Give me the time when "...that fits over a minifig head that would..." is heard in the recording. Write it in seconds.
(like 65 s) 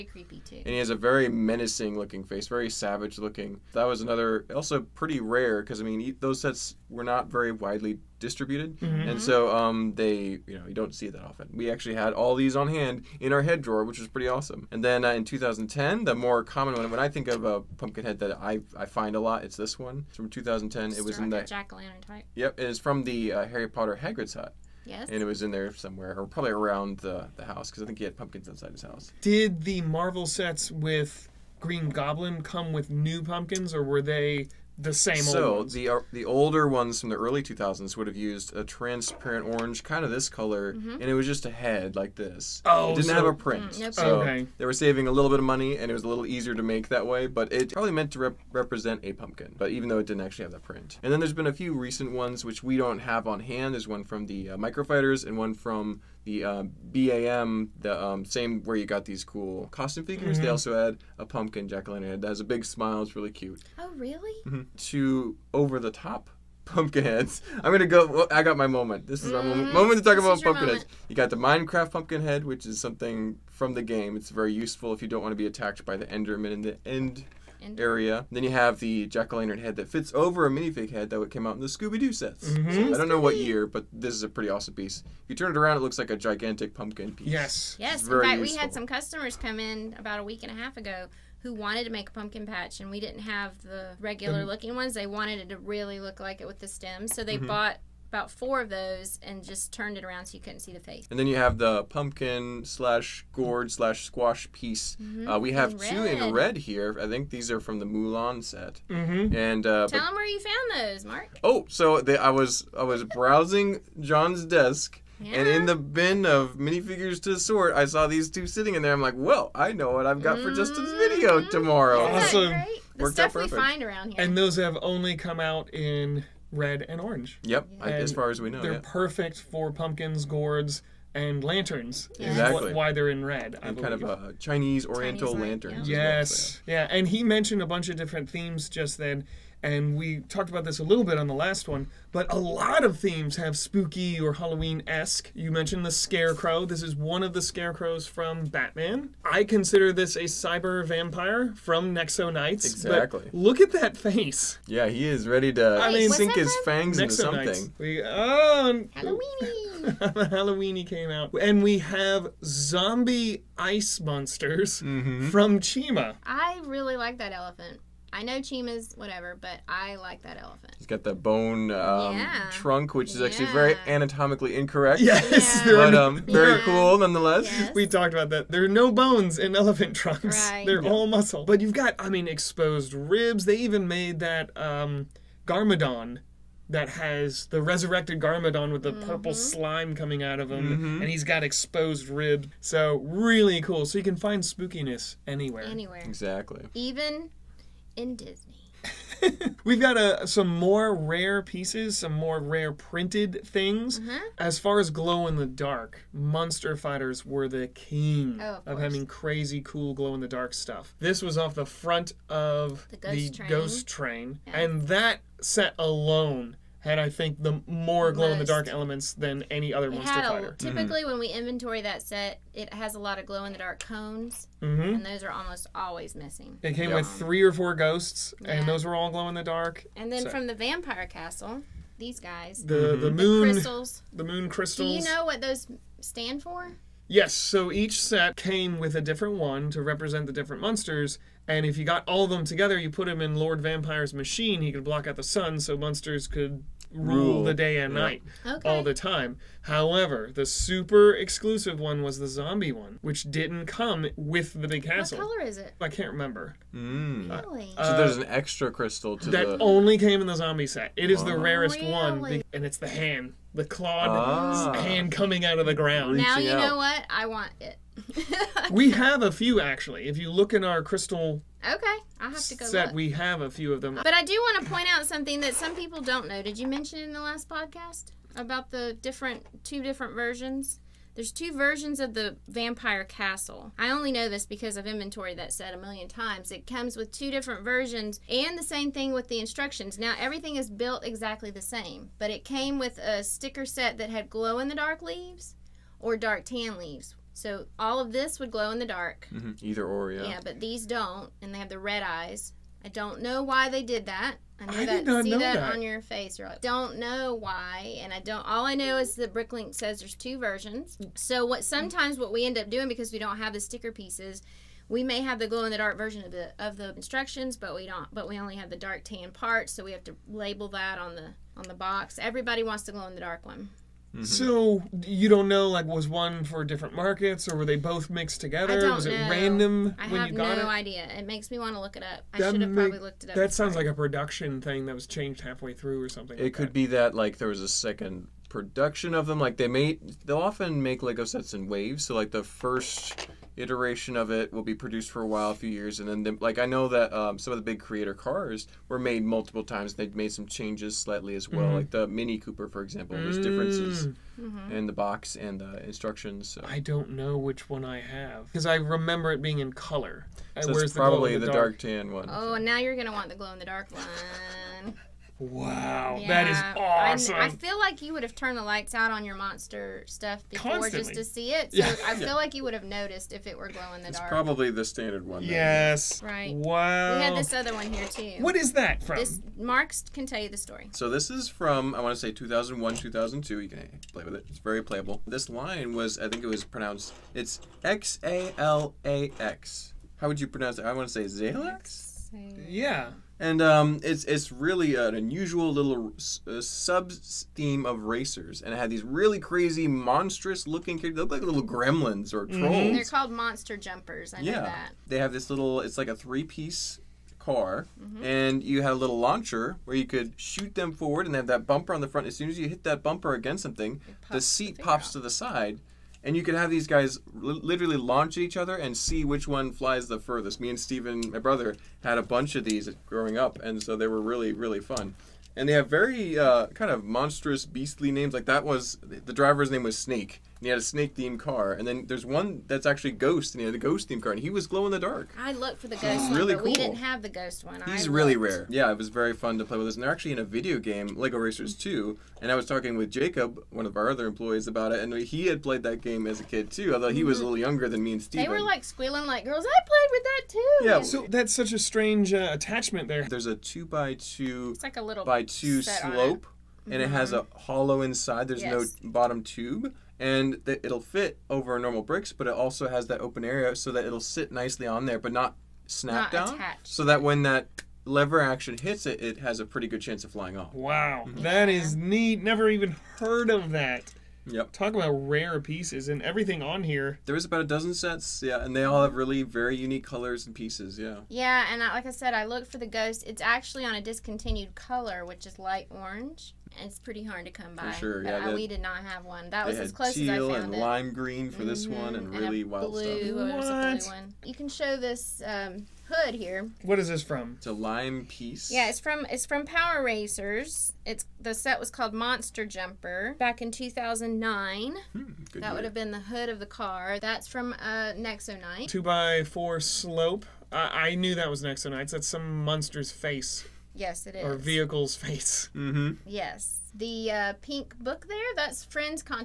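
79 s.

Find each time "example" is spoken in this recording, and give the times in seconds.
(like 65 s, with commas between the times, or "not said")
352 s.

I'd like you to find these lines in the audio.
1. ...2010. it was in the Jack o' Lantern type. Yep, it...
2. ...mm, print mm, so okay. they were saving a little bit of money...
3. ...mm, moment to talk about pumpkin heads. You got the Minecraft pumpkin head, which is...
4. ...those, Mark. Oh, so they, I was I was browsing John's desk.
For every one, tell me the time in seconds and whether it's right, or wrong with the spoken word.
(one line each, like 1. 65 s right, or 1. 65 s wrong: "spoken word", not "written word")
1. 20 s right
2. 43 s right
3. 69 s right
4. 110 s right.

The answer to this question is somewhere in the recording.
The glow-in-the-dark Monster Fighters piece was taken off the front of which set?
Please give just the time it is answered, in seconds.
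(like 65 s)
212 s.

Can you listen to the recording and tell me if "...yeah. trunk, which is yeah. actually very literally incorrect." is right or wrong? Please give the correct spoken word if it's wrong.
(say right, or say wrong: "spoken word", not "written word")
wrong: "anatomically", not "literally".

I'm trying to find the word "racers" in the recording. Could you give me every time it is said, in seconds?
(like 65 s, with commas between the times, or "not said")
398 s, 441 s, 500 s.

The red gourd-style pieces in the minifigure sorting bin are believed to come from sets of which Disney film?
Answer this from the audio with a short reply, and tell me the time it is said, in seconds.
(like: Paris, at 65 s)
Mulan, at 107 s.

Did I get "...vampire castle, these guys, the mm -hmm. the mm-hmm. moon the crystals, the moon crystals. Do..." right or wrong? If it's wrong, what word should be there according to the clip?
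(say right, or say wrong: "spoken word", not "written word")
right.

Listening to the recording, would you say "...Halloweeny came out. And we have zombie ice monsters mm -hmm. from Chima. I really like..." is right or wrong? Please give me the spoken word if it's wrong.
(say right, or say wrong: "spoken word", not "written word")
right.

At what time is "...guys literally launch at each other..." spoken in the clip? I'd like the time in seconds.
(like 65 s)
416 s.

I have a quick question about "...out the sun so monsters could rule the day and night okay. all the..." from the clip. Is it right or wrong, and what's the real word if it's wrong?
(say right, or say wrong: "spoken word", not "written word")
right.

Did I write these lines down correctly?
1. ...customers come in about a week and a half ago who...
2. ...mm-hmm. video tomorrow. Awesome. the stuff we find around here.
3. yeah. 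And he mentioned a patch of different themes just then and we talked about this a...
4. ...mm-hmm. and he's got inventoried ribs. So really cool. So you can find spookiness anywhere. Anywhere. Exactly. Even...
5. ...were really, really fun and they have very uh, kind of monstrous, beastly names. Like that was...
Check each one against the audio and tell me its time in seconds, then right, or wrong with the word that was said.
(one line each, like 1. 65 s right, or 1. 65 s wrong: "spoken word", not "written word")
1. 88 s right
2. 120 s right
3. 136 s wrong: "bunch", not "patch"
4. 190 s wrong: "exposed", not "inventoried"
5. 424 s right.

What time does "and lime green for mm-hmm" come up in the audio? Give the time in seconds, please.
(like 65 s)
490 s.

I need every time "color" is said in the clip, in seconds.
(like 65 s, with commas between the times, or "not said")
40 s, 255 s, 359 s, 480 s, 484 s.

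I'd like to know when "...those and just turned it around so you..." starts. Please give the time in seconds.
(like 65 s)
98 s.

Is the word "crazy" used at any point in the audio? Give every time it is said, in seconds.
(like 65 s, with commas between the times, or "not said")
209 s, 399 s.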